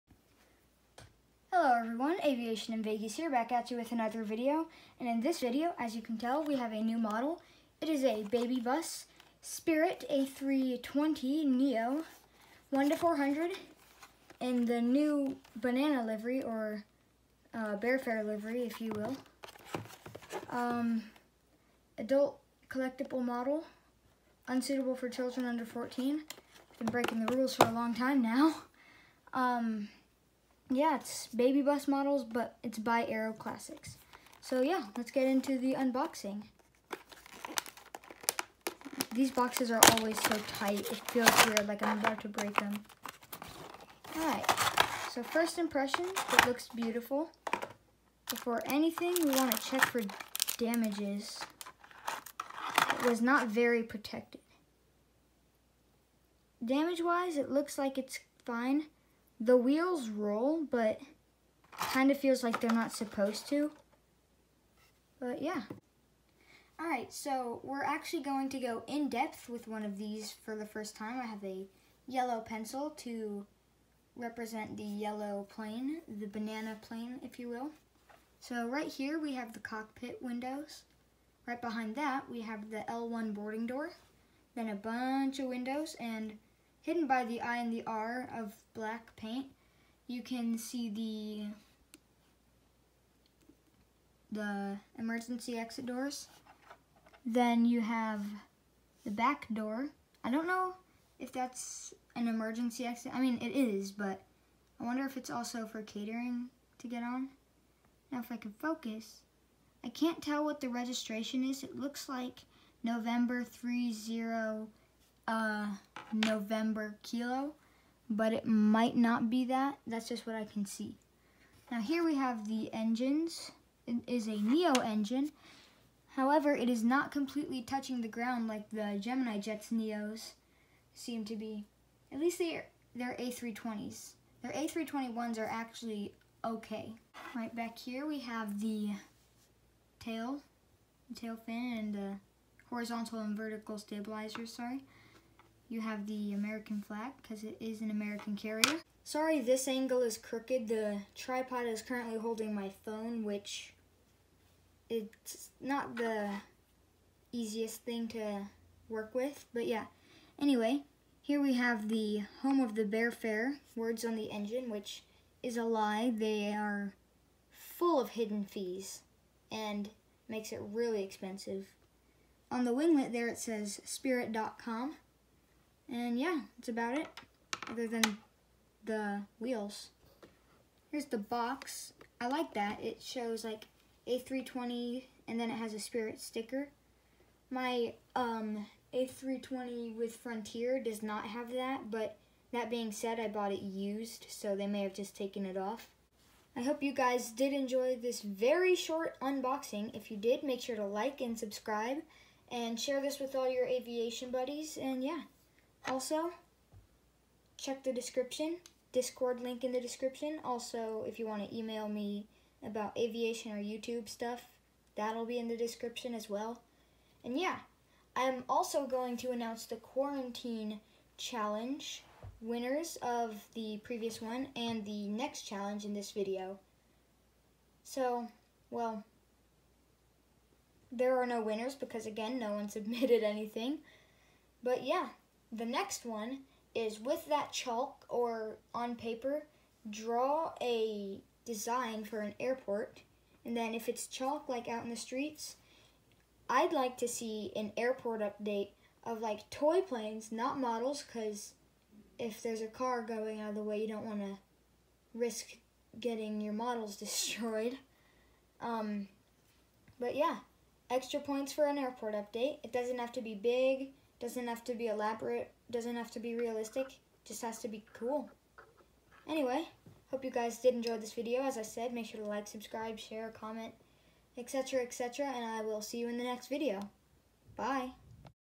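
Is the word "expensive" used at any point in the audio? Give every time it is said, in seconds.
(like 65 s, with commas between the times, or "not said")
171 s.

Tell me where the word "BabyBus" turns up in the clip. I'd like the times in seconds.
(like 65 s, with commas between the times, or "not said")
8 s, 31 s.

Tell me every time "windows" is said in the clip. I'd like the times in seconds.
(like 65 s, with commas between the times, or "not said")
80 s, 85 s.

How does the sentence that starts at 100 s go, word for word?
I don't know if that's an emergency exit.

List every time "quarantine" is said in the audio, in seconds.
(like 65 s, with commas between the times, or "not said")
219 s.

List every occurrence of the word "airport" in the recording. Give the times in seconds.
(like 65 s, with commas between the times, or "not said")
242 s, 247 s, 261 s.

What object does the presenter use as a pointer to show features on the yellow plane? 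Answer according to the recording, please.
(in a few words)
A yellow pencil.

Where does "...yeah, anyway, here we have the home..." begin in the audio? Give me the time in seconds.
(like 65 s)
159 s.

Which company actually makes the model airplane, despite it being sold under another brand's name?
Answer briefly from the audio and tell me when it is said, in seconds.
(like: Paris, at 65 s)
Aeroclassics, at 33 s.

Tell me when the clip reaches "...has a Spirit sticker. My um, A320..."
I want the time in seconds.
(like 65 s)
185 s.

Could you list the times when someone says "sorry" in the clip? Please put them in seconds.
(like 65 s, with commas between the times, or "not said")
144 s, 149 s.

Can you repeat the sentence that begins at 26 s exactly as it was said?
Been breaking the rules for a long time now.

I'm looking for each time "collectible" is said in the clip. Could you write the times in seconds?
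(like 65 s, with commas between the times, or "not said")
22 s.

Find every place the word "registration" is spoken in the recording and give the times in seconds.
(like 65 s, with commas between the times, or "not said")
110 s.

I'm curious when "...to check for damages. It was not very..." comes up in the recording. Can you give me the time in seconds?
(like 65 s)
49 s.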